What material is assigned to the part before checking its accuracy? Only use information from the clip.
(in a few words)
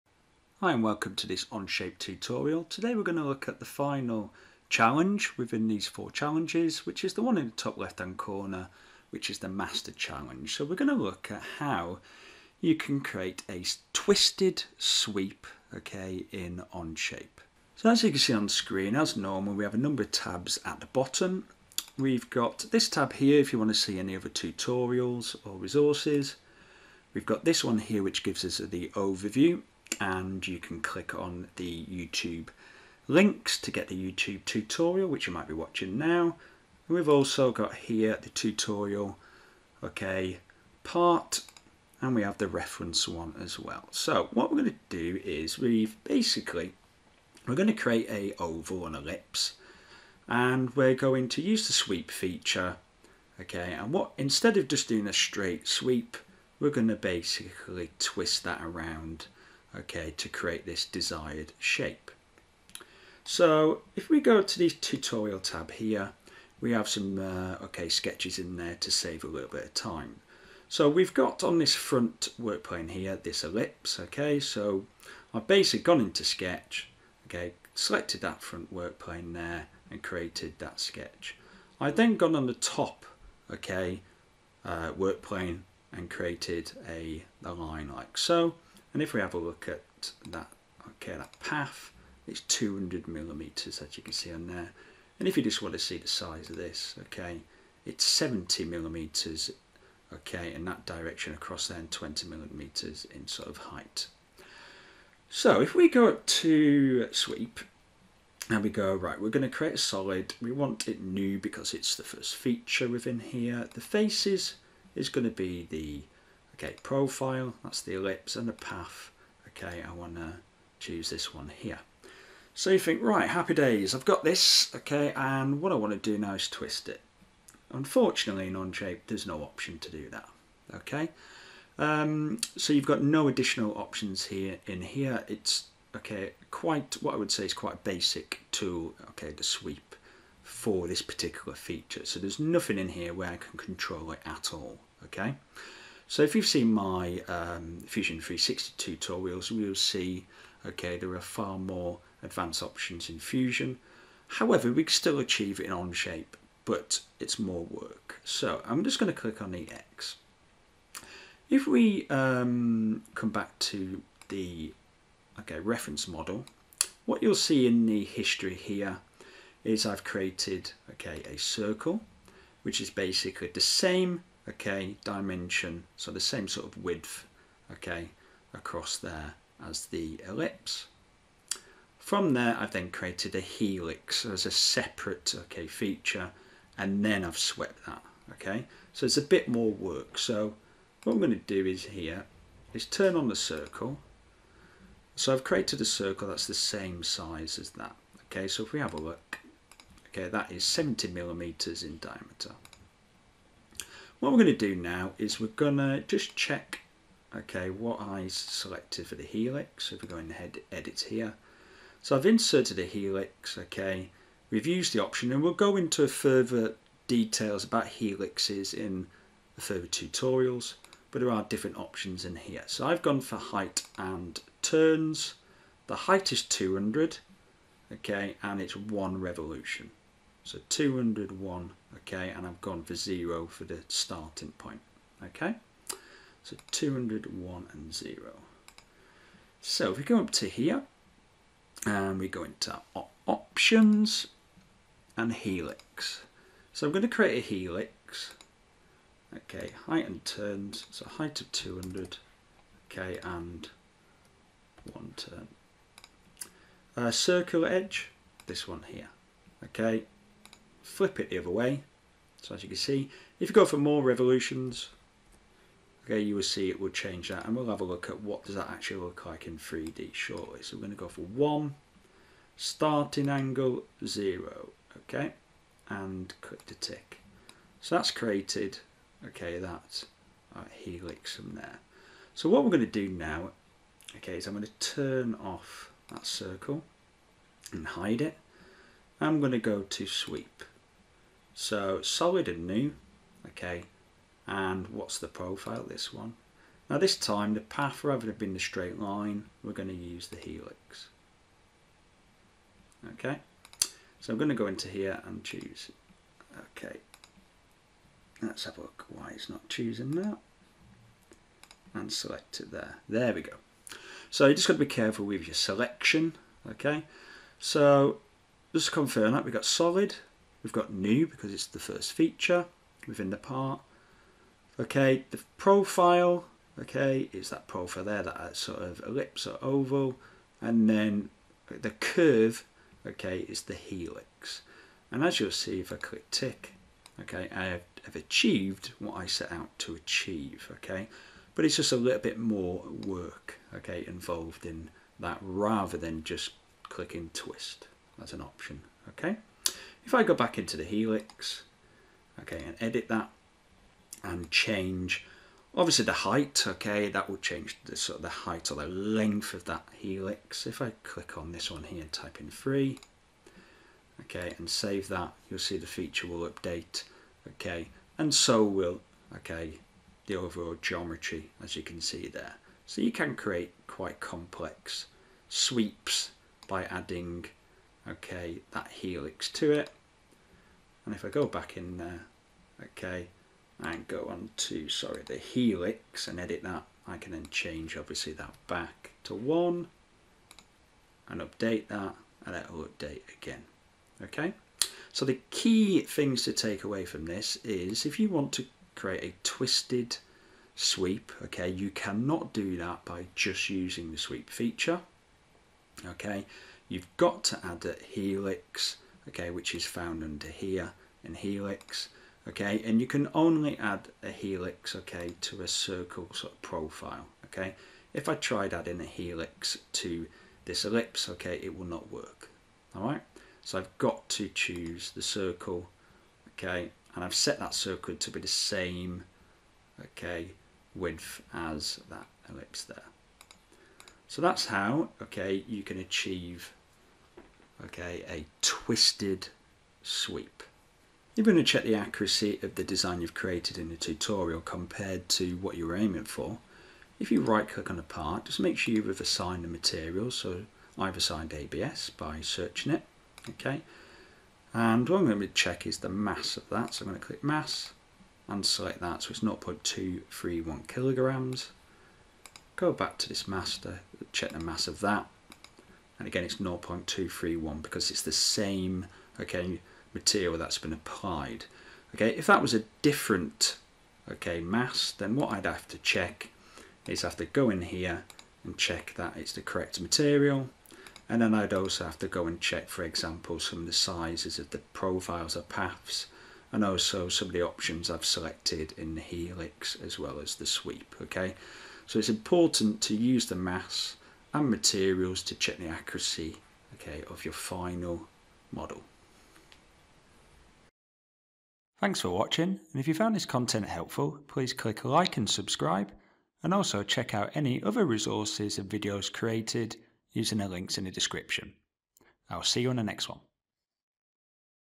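ABS.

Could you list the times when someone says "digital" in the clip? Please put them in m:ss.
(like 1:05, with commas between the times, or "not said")
not said.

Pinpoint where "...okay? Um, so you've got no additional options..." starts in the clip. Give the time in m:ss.
2:10.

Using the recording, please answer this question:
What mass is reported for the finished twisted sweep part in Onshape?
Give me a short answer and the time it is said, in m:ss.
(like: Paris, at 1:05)
0.231 kg, at 7:39.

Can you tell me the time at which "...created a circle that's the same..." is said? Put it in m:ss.
3:15.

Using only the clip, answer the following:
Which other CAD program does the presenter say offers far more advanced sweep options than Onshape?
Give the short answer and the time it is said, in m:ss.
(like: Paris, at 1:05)
Fusion 360, at 2:27.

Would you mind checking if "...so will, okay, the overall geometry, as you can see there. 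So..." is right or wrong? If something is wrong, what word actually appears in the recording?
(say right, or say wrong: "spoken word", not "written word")
right.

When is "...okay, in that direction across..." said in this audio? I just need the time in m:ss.
1:40.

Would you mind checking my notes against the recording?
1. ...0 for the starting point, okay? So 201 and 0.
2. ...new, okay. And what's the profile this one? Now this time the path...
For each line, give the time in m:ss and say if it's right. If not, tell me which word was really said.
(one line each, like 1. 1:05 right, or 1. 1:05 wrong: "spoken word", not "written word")
1. 3:52 right
2. 4:52 right.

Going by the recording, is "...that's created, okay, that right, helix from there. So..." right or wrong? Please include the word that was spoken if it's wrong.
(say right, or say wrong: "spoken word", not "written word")
right.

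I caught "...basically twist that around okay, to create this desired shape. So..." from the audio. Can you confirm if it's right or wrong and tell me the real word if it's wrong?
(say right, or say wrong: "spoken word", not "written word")
right.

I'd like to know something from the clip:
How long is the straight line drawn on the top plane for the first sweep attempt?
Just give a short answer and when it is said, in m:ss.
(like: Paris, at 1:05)
200 mm, at 1:32.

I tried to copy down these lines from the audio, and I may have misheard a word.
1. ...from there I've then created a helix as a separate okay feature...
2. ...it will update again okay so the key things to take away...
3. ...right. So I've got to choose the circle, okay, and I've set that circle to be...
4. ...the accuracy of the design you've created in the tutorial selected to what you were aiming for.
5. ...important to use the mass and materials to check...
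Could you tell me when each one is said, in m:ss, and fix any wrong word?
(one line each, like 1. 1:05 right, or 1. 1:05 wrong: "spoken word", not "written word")
1. 3:01 right
2. 6:32 right
3. 7:03 right
4. 7:21 wrong: "compared", not "selected"
5. 8:12 right.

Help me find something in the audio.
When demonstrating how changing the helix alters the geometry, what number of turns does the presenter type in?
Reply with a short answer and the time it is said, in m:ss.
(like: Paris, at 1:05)
3, at 6:02.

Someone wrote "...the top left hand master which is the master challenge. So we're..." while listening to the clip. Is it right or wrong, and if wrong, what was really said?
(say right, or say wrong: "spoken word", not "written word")
wrong: "corner", not "master".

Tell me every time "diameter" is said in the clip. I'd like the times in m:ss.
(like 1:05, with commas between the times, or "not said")
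3:21.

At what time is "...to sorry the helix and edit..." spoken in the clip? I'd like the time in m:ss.
6:24.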